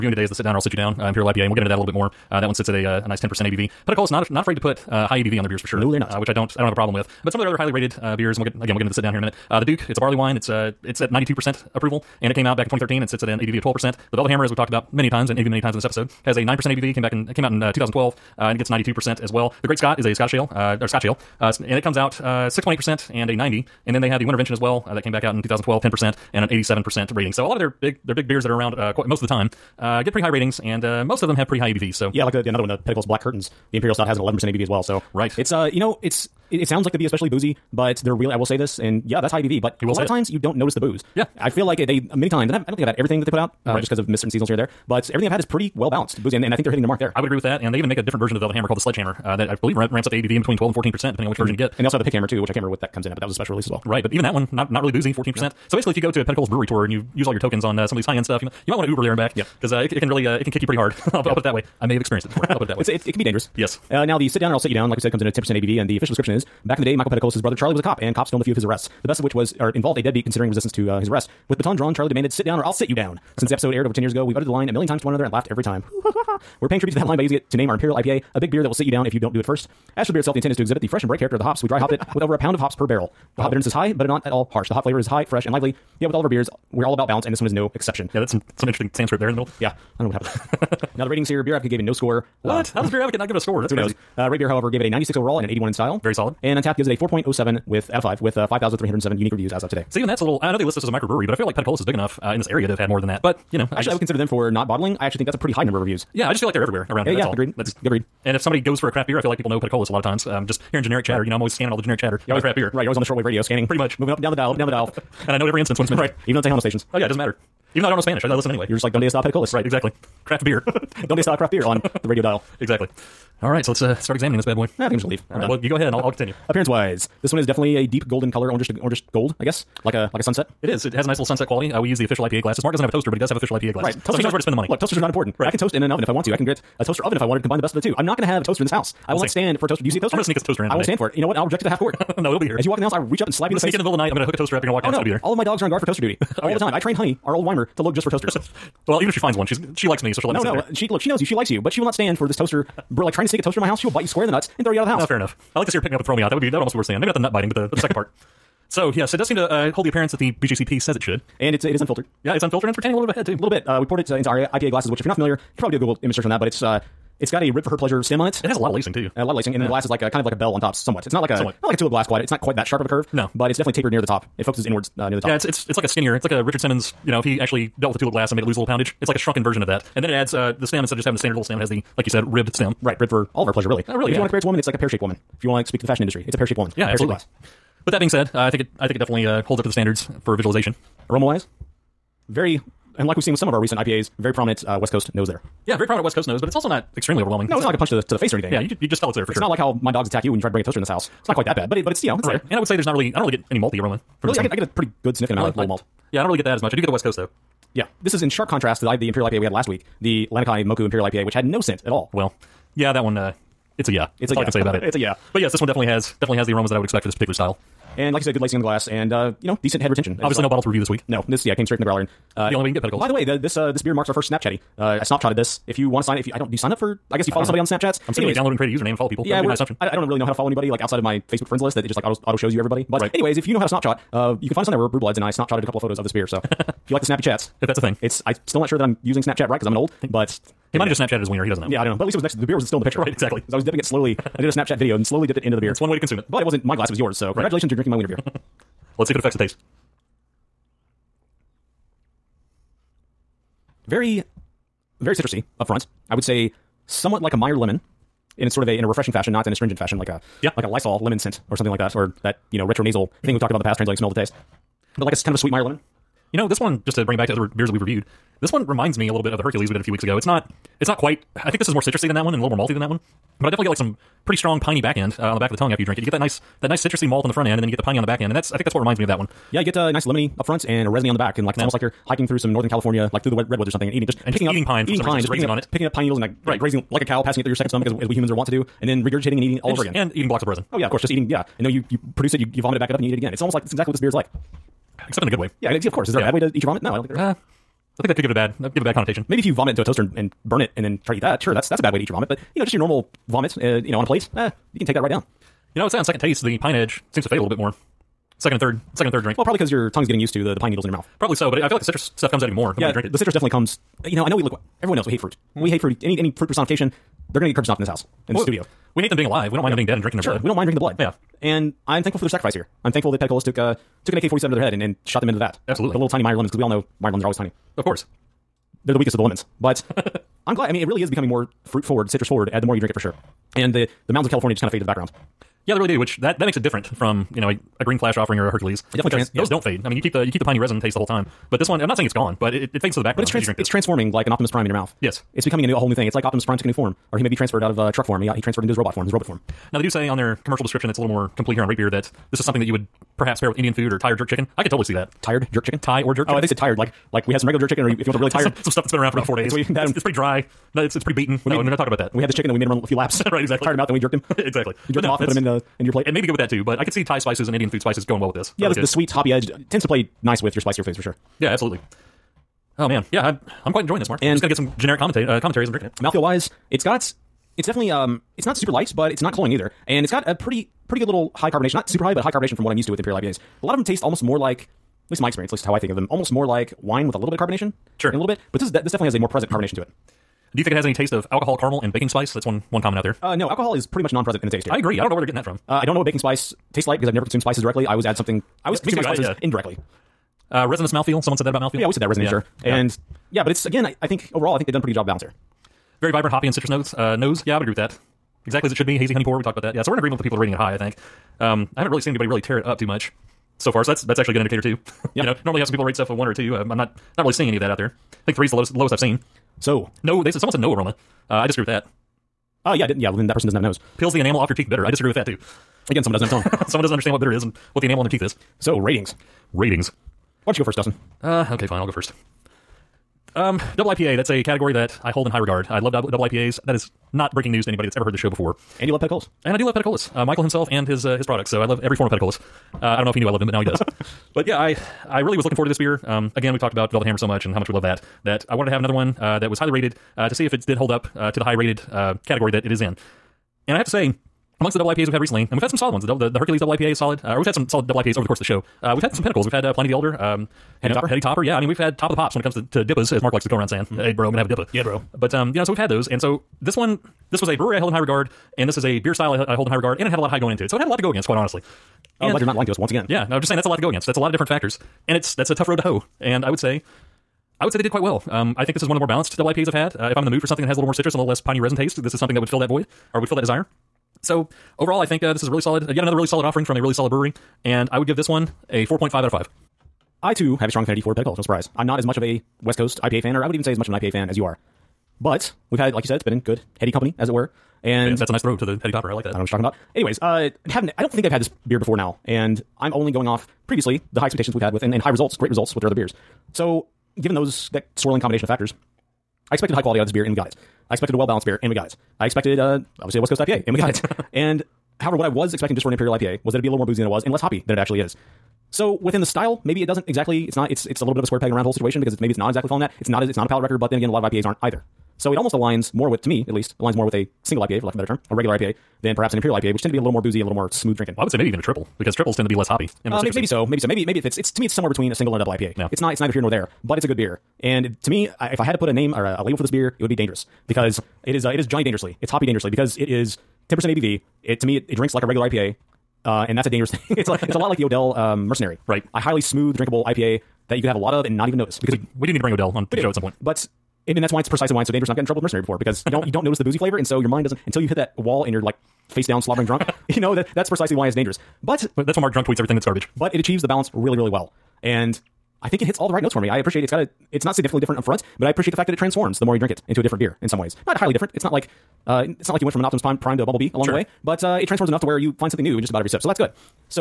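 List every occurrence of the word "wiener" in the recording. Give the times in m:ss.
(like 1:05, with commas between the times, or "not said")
4:01, 4:07.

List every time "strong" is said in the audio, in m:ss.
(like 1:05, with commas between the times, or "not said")
4:34, 8:10.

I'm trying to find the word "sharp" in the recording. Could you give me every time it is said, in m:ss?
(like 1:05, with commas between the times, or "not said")
2:52, 3:28.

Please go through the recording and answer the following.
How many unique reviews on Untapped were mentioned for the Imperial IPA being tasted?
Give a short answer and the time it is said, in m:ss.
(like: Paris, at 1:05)
5,307, at 1:38.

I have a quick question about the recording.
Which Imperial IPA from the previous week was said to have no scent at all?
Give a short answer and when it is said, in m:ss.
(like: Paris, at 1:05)
Lanakai Moku, at 3:30.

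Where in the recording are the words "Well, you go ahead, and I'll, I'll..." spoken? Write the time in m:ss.
2:05.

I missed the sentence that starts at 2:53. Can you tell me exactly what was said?
No, but it's definitely tapered near the top.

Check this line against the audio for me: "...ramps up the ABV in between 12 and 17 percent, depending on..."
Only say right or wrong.
wrong.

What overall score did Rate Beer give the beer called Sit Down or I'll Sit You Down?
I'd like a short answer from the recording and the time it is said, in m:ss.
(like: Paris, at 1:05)
96, at 1:34.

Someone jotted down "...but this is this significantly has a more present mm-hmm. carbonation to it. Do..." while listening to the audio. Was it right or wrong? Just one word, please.
wrong.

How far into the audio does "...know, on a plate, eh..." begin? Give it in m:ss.
5:03.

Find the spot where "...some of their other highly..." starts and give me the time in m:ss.
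0:07.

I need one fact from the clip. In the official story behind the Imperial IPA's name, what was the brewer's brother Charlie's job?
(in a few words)
cop.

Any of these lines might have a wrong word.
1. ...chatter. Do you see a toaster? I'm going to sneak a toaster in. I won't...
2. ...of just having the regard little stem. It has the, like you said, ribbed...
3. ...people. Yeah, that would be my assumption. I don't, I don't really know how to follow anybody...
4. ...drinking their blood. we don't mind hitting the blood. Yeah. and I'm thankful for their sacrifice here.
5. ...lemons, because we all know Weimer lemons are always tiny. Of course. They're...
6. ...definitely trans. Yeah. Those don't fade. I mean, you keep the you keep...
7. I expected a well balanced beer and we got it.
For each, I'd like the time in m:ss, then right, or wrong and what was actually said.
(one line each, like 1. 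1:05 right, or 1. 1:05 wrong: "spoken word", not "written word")
1. 2:19 wrong: "toaster", not "chatter"
2. 3:00 wrong: "standard", not "regard"
3. 3:49 right
4. 5:20 wrong: "drinking", not "hitting"
5. 5:26 wrong: "Meyer", not "Weimer"
6. 5:38 right
7. 8:30 right.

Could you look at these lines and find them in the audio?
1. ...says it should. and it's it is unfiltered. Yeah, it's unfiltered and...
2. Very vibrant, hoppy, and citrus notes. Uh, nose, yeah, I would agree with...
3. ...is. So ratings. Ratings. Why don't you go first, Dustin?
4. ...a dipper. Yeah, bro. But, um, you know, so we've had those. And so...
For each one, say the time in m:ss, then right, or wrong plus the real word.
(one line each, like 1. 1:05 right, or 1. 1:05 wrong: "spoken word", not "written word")
1. 2:40 right
2. 6:46 right
3. 7:08 right
4. 7:44 right.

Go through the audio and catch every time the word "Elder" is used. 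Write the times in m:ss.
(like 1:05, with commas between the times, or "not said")
7:39.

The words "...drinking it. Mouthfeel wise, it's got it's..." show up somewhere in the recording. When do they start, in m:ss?
6:15.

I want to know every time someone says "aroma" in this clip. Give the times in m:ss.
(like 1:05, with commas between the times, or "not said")
3:11, 3:23, 3:36, 7:00.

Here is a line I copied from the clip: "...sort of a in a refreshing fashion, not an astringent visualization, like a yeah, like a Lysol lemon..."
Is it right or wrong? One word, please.
wrong.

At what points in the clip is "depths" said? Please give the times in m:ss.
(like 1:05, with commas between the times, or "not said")
not said.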